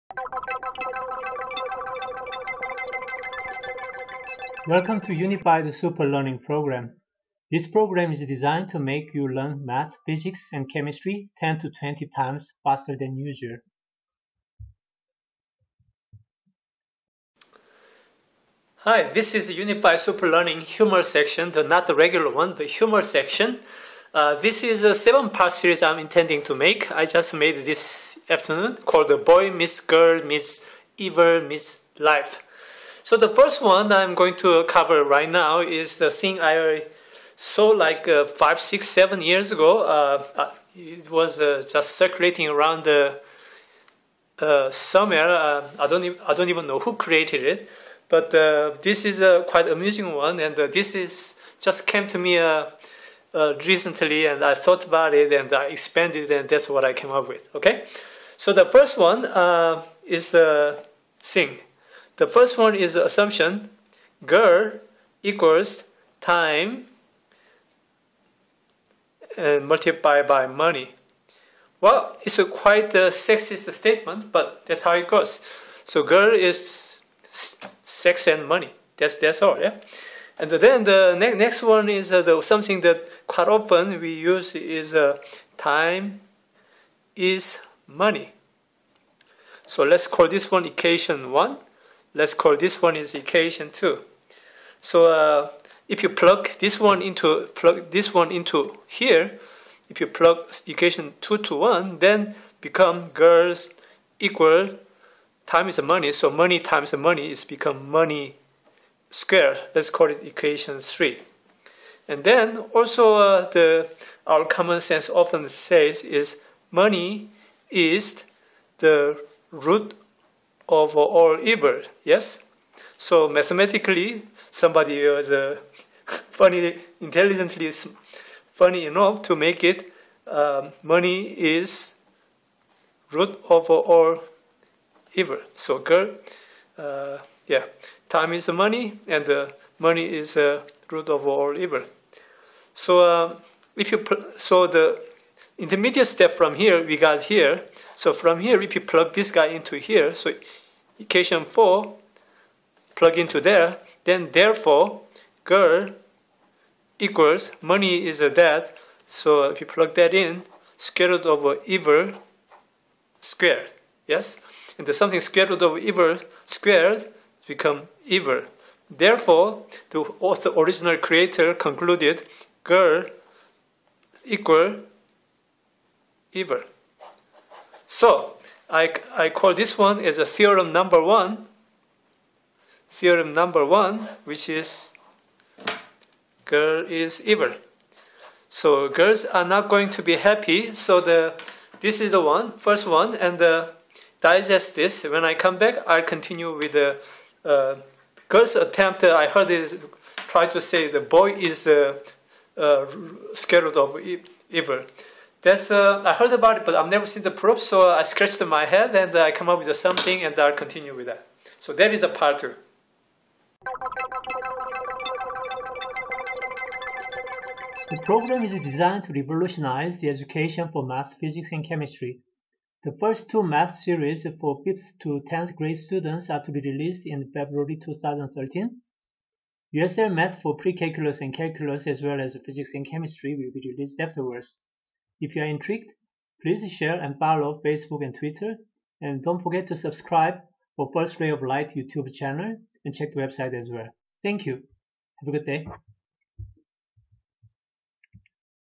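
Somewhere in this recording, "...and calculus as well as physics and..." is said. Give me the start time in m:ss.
3:51.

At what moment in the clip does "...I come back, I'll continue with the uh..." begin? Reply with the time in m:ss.
3:15.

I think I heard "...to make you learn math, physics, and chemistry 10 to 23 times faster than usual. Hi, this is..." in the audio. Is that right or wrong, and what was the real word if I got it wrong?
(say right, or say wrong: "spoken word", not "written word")
wrong: "20", not "23".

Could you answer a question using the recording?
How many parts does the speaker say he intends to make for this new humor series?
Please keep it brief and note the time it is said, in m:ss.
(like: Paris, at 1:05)
7, at 0:38.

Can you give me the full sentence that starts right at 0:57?
Okay, so the first one is the thing.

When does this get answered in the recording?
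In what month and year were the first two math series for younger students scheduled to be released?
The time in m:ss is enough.
3:47.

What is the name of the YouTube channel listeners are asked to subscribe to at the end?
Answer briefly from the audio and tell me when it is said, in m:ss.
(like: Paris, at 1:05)
First Ray of Light, at 4:00.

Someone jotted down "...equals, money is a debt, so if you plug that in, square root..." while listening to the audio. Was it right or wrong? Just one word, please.
right.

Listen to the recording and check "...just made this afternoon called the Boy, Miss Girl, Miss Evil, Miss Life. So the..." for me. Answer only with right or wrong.
right.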